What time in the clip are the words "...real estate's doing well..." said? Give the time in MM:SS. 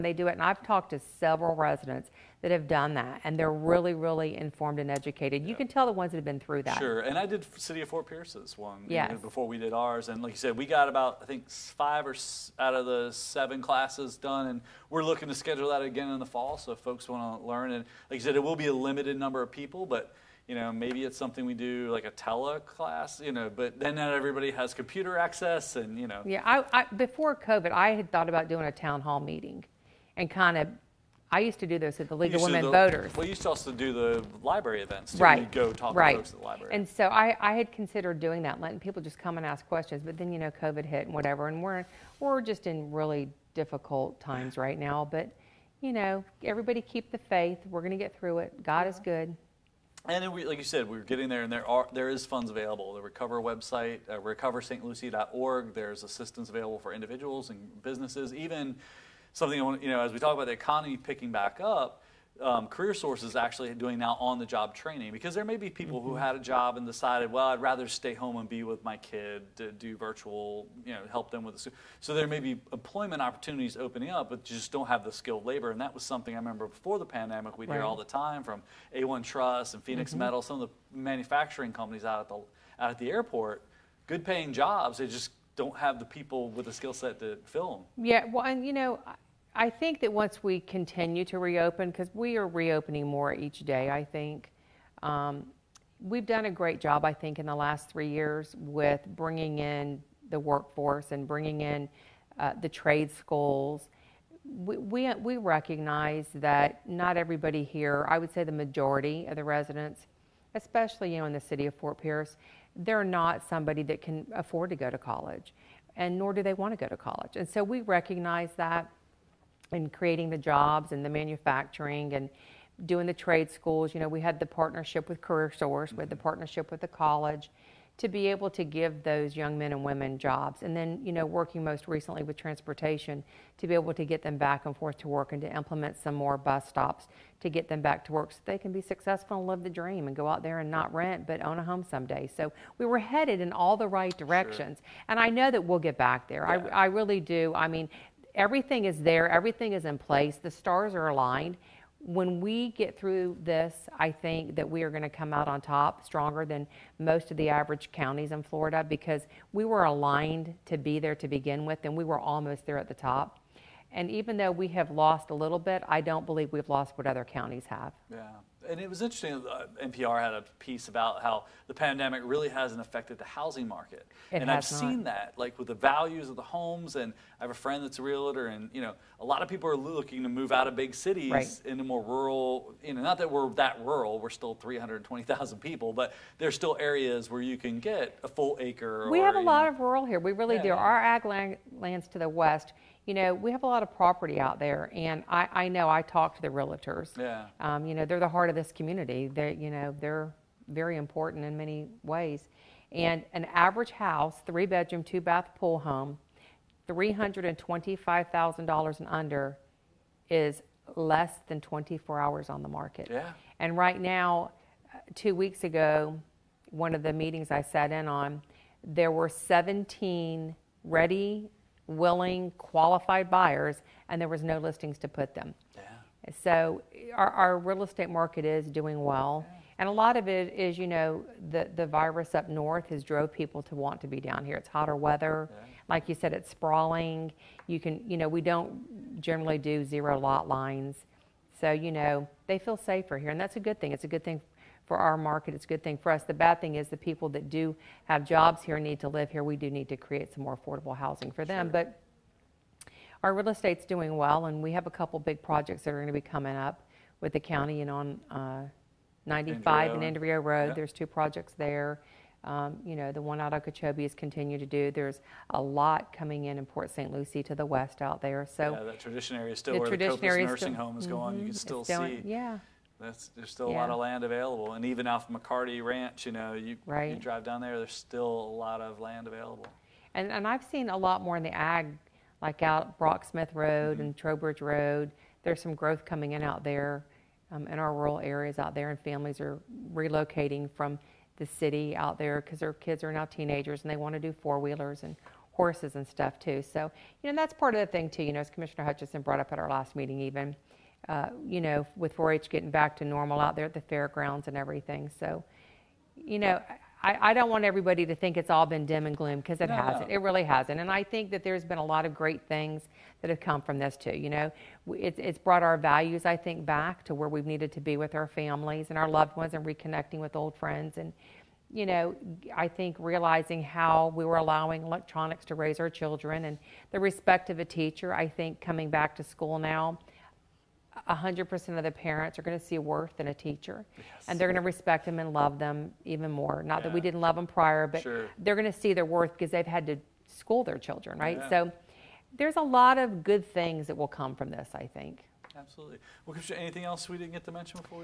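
04:13.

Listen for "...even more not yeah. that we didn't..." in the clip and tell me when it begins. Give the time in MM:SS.
05:36.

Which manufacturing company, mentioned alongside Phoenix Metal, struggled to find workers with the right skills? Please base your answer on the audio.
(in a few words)
A1 Truss.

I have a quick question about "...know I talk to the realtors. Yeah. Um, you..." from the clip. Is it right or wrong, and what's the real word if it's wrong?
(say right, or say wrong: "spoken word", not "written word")
right.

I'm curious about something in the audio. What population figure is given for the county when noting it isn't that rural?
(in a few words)
320,000.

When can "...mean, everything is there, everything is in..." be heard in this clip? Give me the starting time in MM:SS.
02:27.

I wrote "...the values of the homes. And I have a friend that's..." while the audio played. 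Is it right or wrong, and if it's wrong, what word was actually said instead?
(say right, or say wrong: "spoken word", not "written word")
right.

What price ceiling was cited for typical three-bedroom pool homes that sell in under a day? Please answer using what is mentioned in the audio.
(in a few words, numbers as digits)
$325,000.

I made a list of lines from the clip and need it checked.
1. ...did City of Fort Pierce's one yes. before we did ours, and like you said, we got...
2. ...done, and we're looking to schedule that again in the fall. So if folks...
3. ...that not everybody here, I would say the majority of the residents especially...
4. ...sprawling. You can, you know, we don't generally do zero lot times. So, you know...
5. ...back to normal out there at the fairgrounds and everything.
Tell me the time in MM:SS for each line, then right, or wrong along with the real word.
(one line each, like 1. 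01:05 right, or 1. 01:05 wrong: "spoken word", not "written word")
1. 00:07 right
2. 00:14 right
3. 01:46 right
4. 03:56 wrong: "lines", not "times"
5. 05:02 right.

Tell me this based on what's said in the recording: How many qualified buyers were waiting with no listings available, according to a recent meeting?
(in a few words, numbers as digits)
17.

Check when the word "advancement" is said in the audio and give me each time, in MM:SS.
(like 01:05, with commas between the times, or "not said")
not said.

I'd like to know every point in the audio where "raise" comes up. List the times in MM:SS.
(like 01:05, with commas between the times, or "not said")
05:25.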